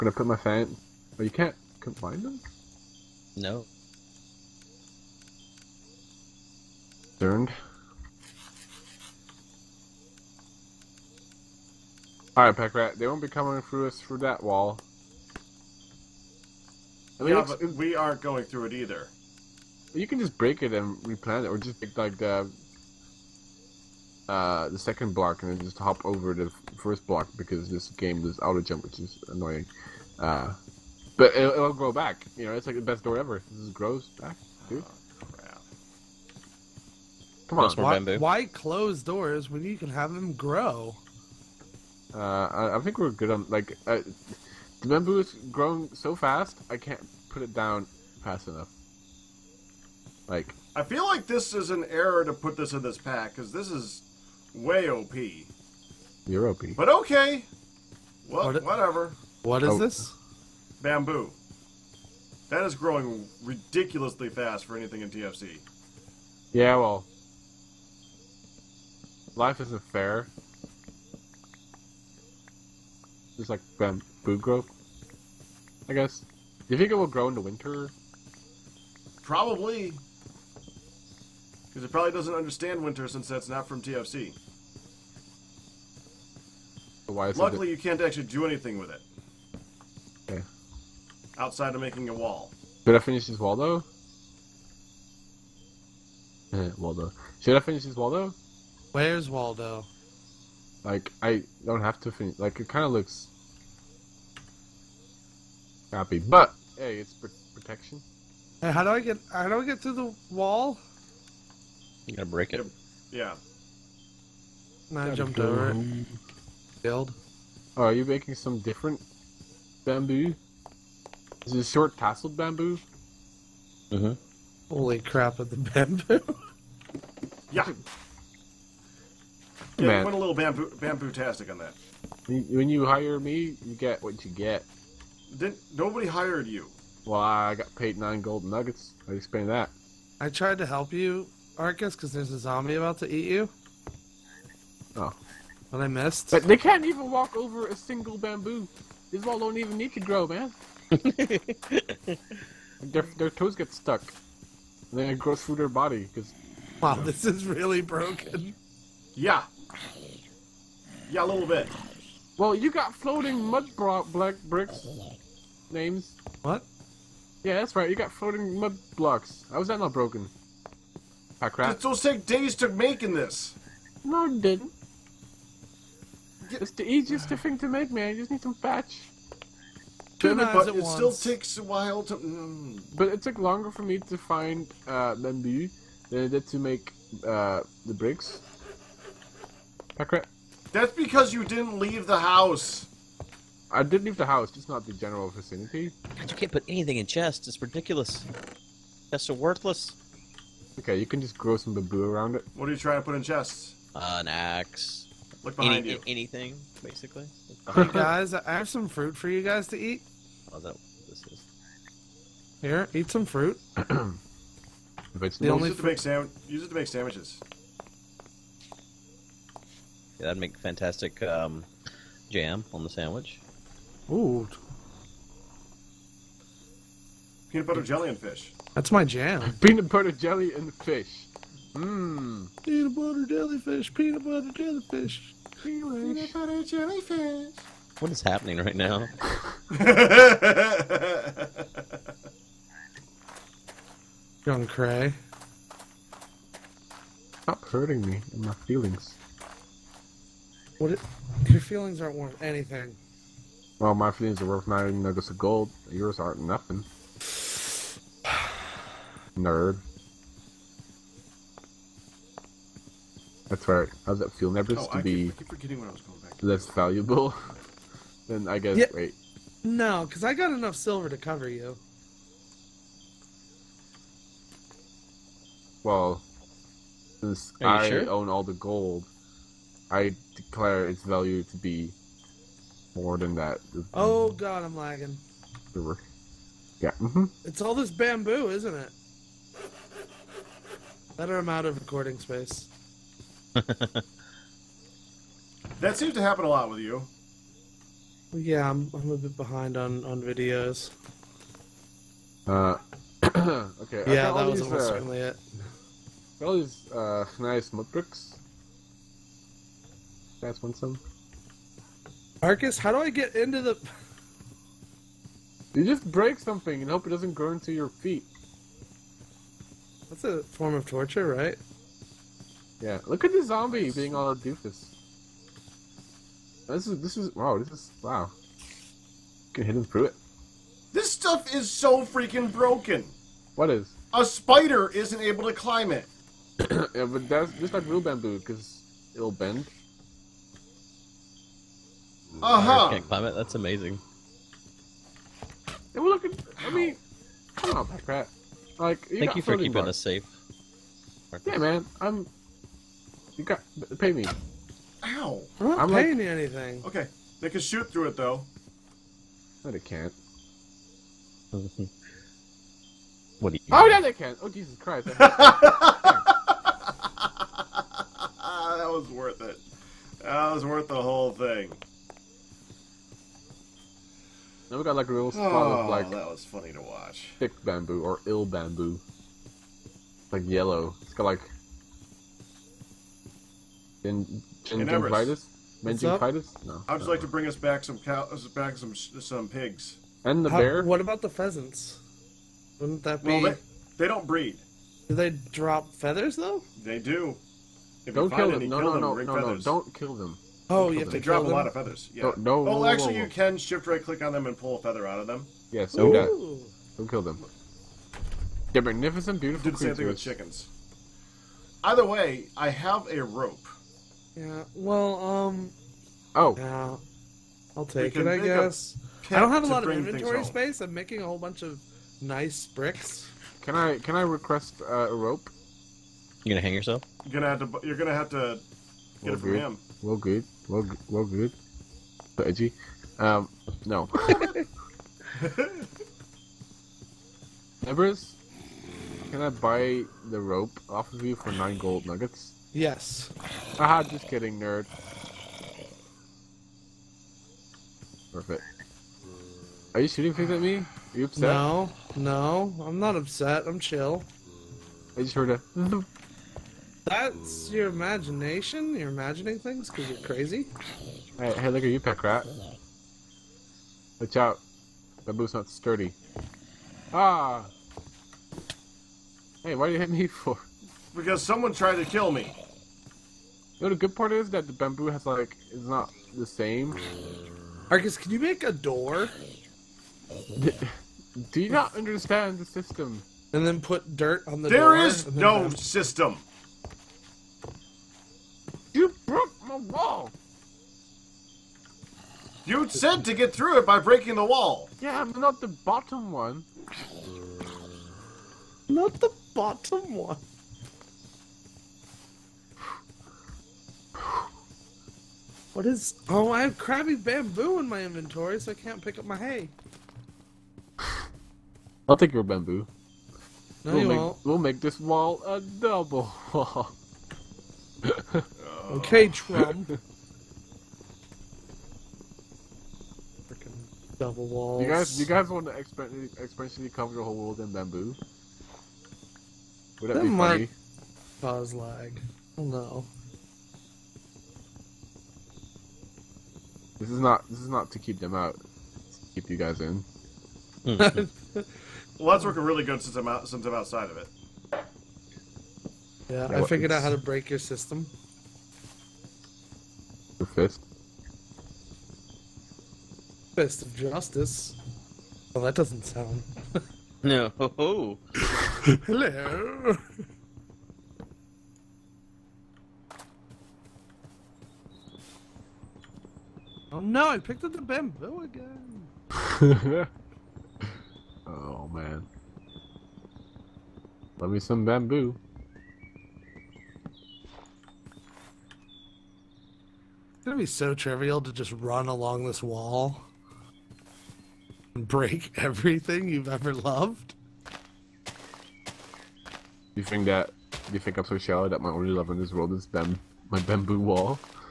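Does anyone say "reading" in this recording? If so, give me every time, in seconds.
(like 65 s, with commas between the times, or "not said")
not said.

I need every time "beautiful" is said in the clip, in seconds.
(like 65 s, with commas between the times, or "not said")
409 s.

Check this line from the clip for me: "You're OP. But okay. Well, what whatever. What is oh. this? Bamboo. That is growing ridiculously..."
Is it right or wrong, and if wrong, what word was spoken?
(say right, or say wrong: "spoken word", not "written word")
right.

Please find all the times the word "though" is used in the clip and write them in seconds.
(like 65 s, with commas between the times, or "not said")
93 s, 358 s, 396 s.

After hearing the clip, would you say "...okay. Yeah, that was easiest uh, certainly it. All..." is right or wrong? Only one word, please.
wrong.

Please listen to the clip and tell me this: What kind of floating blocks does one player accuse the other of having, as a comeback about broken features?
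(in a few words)
Mud blocks.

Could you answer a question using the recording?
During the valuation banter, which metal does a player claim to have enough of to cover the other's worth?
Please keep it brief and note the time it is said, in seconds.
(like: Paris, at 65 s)
Silver, at 270 s.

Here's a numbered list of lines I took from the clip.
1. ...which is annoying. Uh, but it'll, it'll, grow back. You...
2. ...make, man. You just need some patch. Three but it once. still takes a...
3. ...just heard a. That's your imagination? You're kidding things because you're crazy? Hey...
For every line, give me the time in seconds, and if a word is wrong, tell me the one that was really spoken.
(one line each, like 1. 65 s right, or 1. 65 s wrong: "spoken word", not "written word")
1. 28 s right
2. 177 s wrong: "Two", not "Three"
3. 455 s wrong: "imagining", not "kidding".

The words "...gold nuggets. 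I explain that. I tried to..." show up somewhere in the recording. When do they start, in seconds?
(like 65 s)
138 s.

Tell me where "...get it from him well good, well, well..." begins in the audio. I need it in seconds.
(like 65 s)
429 s.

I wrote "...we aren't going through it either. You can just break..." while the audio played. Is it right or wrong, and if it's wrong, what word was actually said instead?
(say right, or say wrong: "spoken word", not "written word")
right.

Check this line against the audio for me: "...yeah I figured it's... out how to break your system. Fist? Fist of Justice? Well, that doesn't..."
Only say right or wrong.
right.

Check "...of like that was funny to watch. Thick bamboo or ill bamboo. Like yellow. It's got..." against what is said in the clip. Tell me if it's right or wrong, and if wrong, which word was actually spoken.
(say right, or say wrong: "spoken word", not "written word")
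right.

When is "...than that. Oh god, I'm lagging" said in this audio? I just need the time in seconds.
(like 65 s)
283 s.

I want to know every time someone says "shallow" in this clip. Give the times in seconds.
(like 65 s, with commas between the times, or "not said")
591 s.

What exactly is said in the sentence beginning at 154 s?
And then it grows through their body.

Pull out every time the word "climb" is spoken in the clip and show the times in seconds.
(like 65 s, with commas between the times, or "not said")
335 s, 343 s.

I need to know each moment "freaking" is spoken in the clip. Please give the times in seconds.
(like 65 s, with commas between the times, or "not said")
332 s, 523 s.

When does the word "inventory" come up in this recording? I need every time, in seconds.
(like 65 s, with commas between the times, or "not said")
419 s, 508 s.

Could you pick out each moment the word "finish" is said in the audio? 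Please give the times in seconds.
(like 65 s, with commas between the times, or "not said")
93 s, 97 s, 102 s.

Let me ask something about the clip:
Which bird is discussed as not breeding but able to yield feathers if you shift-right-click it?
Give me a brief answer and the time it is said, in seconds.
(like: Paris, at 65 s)
Pheasants, at 391 s.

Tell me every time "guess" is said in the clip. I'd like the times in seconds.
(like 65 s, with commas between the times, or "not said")
75 s, 268 s, 418 s.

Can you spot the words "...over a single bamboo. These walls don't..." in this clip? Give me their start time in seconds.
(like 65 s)
147 s.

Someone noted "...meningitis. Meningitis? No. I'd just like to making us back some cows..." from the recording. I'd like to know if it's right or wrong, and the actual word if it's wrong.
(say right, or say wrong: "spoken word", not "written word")
wrong: "bring", not "making".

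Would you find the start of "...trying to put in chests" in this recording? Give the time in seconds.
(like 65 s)
202 s.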